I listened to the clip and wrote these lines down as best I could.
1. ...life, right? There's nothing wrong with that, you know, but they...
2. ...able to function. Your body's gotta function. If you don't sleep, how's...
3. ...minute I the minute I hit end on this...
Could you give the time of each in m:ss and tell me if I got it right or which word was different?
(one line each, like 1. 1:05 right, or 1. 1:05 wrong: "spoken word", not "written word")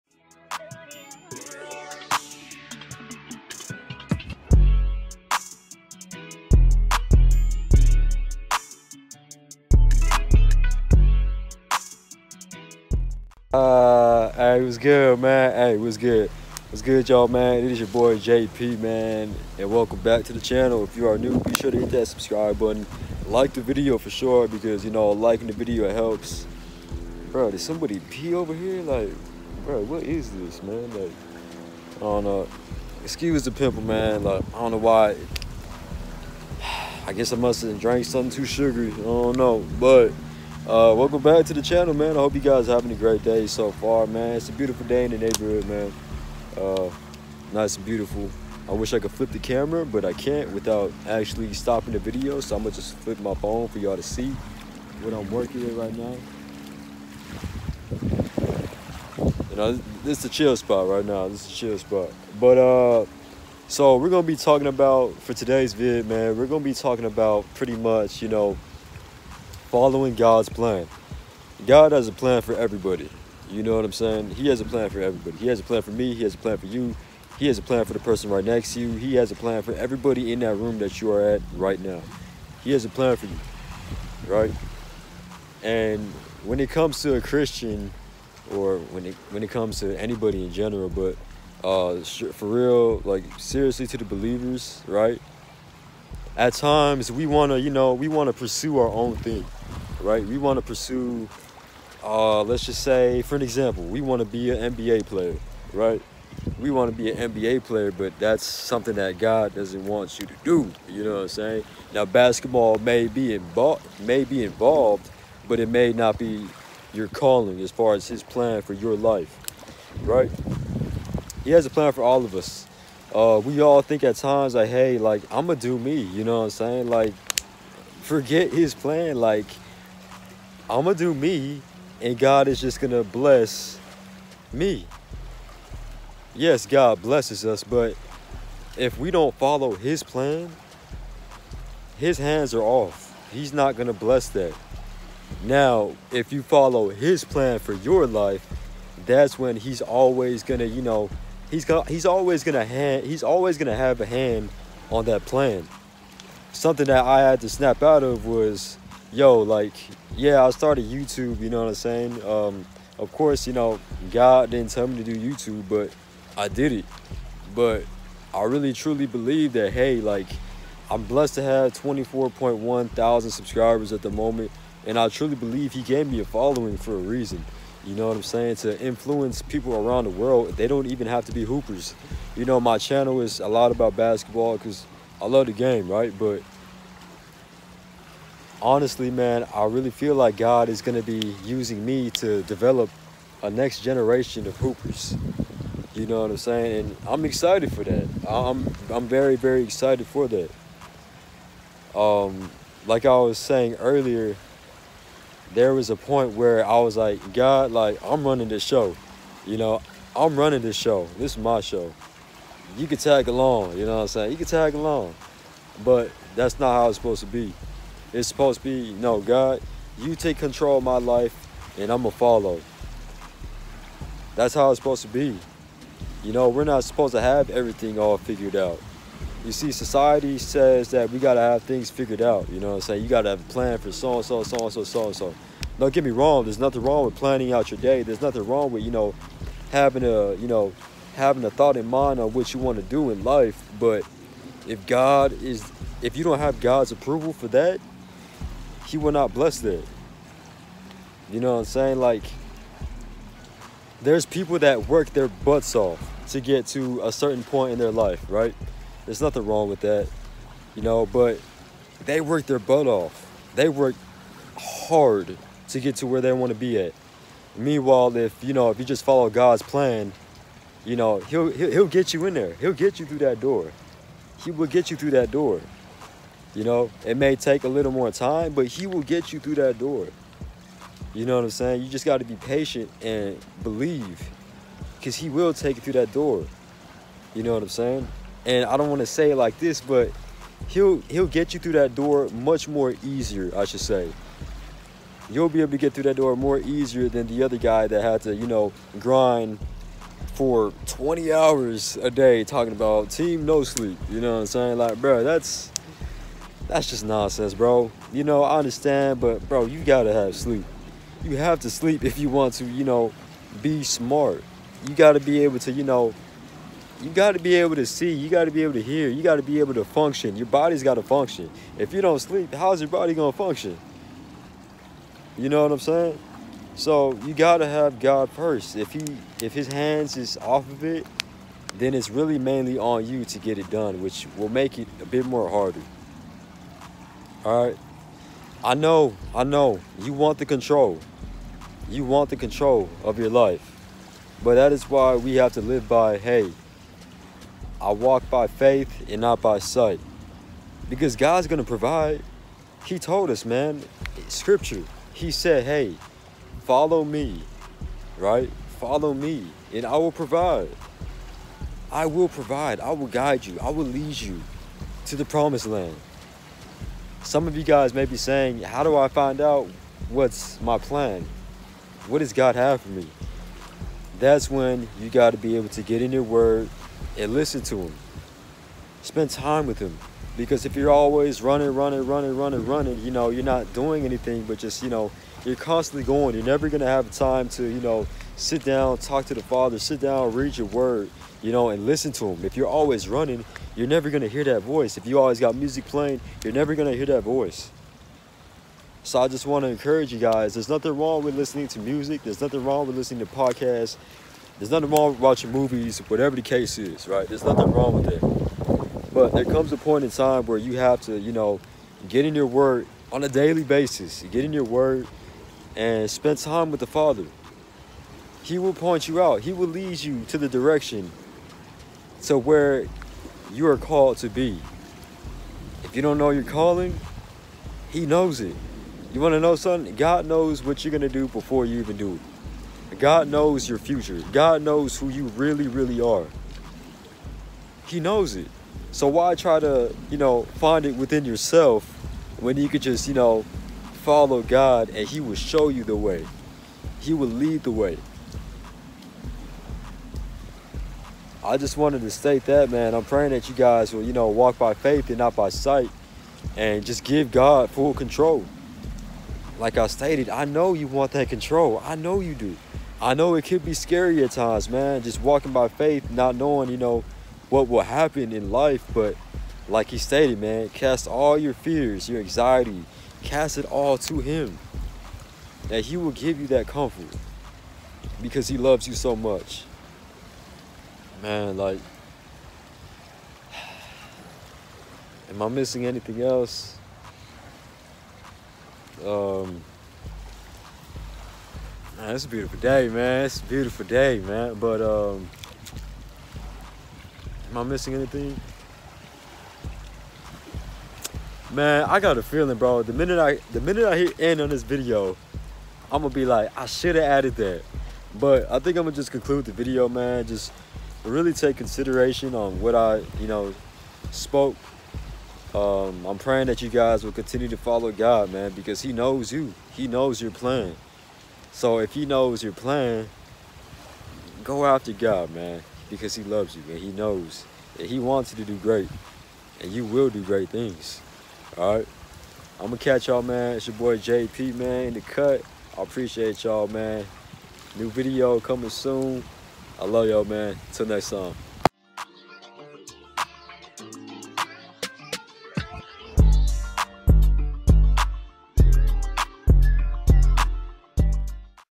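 1. 4:17 right
2. 5:19 right
3. 8:22 right.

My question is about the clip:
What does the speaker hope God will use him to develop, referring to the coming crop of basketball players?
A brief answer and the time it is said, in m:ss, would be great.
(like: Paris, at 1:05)
next generation of hoopers, at 3:13.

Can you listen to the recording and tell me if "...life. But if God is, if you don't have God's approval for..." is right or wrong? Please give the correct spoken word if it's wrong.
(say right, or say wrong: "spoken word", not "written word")
right.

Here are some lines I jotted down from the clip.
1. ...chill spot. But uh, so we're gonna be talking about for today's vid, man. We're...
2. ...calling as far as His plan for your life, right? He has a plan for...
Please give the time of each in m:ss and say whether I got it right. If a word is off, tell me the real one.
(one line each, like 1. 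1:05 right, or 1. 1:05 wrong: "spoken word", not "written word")
1. 1:01 right
2. 1:57 right.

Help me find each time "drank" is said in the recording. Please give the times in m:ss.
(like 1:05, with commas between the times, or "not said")
0:37.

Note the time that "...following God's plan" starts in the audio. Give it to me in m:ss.
1:09.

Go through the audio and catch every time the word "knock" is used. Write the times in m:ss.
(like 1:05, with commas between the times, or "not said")
not said.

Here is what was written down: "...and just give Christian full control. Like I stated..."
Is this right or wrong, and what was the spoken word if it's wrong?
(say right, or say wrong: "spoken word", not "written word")
wrong: "God", not "Christian".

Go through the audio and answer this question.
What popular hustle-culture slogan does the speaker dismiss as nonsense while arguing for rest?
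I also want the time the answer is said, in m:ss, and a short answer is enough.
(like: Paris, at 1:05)
team no sleep, at 5:03.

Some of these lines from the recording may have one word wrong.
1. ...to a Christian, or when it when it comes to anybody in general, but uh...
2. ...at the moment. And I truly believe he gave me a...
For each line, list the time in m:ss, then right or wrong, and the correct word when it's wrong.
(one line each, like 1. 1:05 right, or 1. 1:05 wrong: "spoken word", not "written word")
1. 1:27 right
2. 2:53 right.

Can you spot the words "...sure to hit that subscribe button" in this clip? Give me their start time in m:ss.
0:21.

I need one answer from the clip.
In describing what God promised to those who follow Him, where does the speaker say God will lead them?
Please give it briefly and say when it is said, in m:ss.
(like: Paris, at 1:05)
the promised land, at 6:05.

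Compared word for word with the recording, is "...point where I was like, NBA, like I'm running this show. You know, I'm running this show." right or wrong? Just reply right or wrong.
wrong.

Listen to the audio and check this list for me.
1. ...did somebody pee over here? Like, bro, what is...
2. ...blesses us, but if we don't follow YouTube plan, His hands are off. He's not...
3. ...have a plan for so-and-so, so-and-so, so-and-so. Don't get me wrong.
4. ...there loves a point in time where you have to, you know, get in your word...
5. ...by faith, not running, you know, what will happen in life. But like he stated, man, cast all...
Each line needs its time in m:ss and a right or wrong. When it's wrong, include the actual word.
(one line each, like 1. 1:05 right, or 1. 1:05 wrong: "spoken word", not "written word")
1. 0:27 right
2. 2:17 wrong: "His", not "YouTube"
3. 3:53 right
4. 6:49 wrong: "comes", not "loves"
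5. 7:45 wrong: "knowing", not "running".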